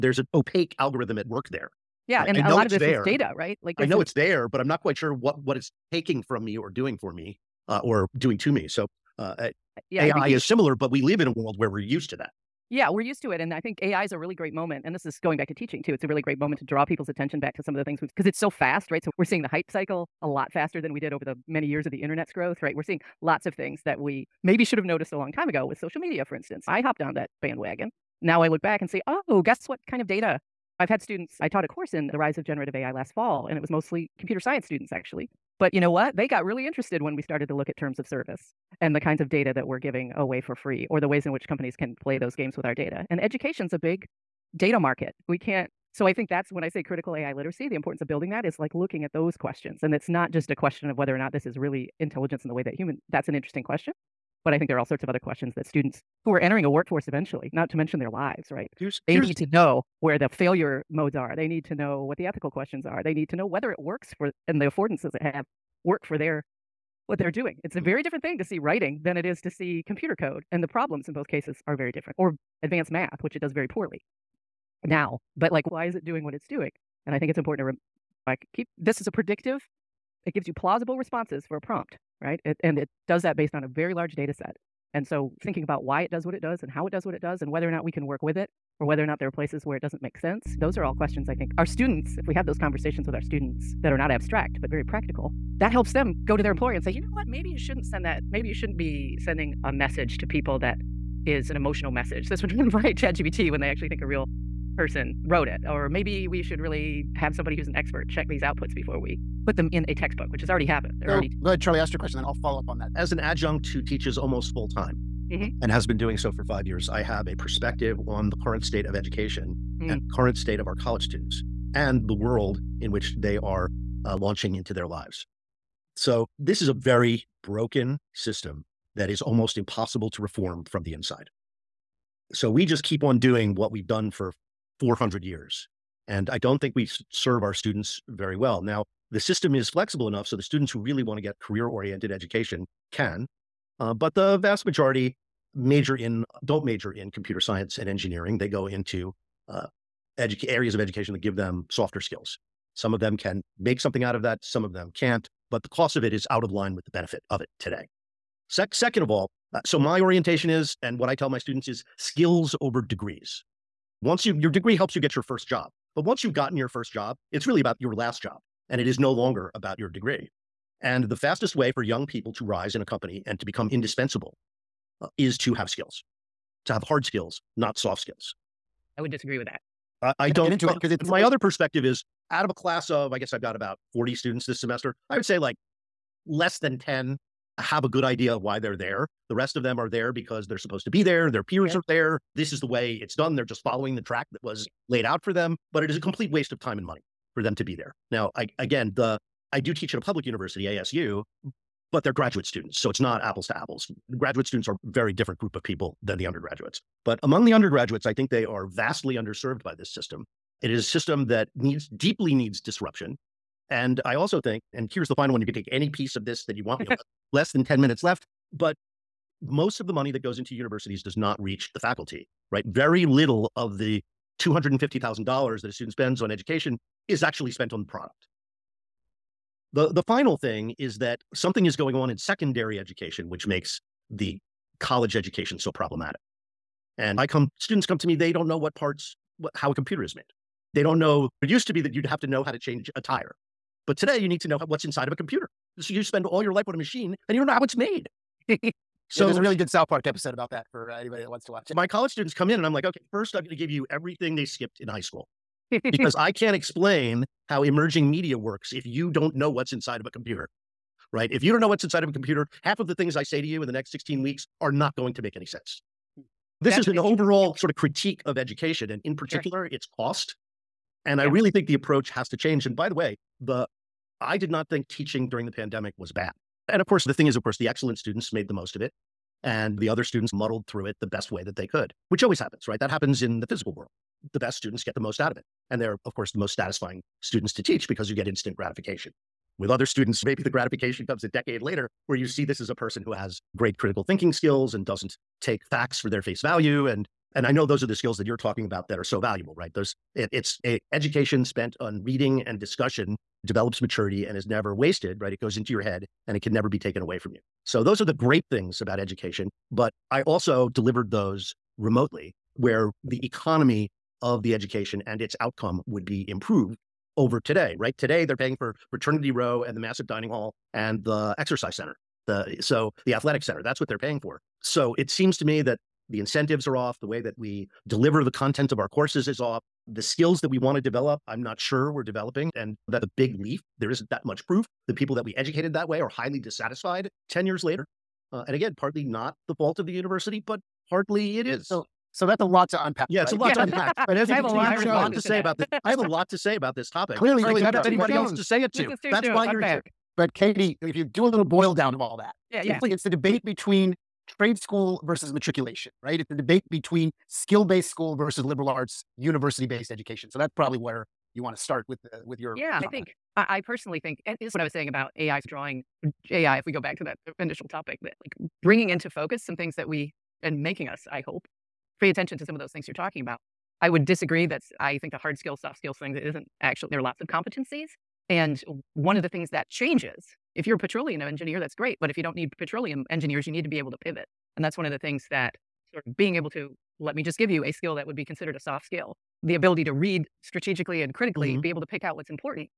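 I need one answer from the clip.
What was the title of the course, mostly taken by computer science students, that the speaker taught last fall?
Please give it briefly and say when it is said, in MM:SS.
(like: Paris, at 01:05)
The rise of generative AI, at 00:32.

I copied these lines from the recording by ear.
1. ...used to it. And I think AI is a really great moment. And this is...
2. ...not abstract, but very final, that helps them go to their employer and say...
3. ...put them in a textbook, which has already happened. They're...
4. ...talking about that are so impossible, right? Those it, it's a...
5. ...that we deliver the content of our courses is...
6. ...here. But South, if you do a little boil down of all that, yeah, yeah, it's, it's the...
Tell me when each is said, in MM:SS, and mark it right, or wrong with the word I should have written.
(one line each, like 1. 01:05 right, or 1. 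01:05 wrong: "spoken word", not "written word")
1. 00:13 right
2. 01:33 wrong: "practical", not "final"
3. 01:49 right
4. 04:58 wrong: "valuable", not "impossible"
5. 05:27 right
6. 05:49 wrong: "Katie", not "South".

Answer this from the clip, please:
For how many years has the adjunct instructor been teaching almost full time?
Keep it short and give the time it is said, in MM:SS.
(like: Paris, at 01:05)
5, at 01:56.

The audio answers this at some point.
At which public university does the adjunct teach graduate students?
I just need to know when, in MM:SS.
03:20.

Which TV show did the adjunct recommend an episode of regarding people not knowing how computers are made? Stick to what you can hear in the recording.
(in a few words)
South Park.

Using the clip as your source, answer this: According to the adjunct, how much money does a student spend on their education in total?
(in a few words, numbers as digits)
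$250,000.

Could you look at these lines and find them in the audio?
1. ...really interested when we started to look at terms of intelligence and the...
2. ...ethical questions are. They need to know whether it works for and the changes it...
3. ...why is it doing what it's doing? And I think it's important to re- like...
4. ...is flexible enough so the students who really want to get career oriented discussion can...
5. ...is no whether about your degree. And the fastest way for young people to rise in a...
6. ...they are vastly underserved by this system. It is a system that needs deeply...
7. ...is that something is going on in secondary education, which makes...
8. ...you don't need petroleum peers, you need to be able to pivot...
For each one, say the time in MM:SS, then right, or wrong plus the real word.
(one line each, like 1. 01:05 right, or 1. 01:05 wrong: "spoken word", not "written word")
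1. 00:36 wrong: "service", not "intelligence"
2. 01:02 wrong: "affordances", not "changes"
3. 01:15 right
4. 02:19 wrong: "education", not "discussion"
5. 02:48 wrong: "longer", not "whether"
6. 03:28 right
7. 03:50 right
8. 06:22 wrong: "engineers", not "peers".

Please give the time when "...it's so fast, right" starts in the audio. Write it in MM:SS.
00:18.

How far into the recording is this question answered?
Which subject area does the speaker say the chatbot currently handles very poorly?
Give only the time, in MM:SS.
01:12.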